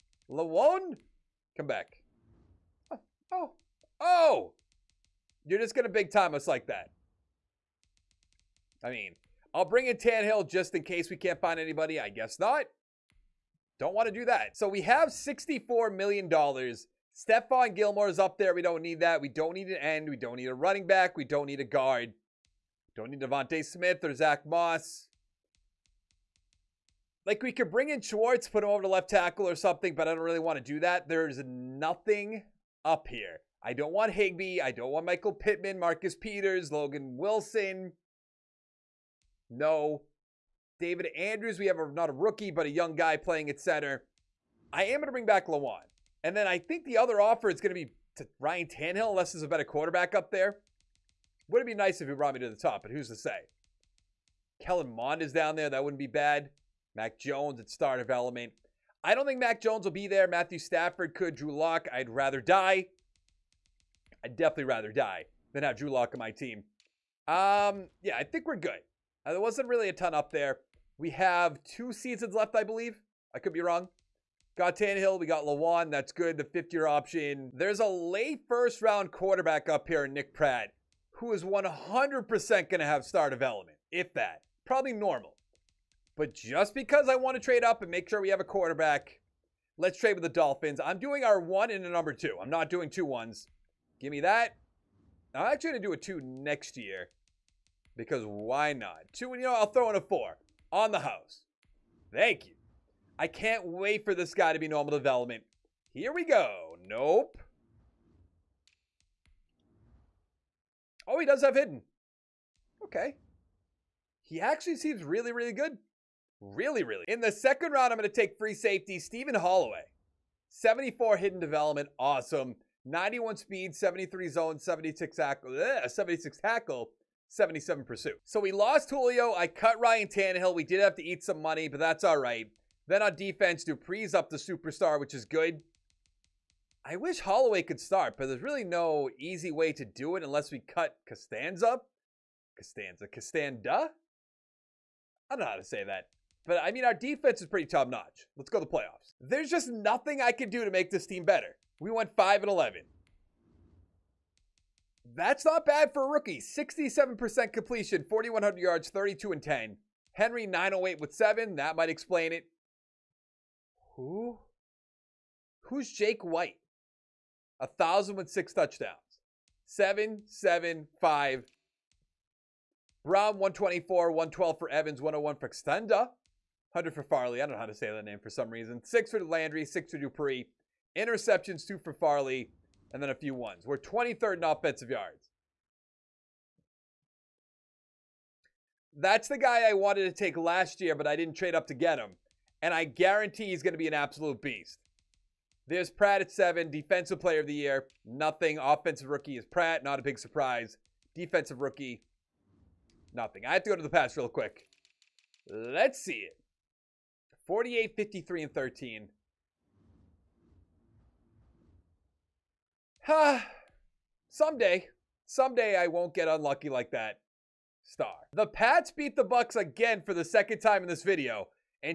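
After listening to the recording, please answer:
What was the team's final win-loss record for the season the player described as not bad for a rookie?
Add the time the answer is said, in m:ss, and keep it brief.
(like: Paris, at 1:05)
5-11, at 2:32.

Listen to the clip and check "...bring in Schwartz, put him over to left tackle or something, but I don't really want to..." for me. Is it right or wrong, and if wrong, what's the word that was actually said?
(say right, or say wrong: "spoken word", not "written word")
right.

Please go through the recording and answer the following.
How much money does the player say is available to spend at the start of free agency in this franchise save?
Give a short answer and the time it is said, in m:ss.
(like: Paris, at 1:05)
$64 million, at 0:15.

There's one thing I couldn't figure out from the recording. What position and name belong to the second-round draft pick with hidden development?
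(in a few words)
Free safety Stephen Holloway.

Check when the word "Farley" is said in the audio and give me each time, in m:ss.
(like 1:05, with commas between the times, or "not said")
2:57, 3:01.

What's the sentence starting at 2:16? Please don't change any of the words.
I wish Holloway could start, but there's really no easy way to do it unless we cut Costanza.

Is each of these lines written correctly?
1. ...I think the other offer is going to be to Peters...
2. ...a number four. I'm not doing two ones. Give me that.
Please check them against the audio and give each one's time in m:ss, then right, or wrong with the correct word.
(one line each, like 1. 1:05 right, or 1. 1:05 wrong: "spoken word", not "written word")
1. 0:46 wrong: "Ryan", not "Peters"
2. 1:31 wrong: "two", not "four".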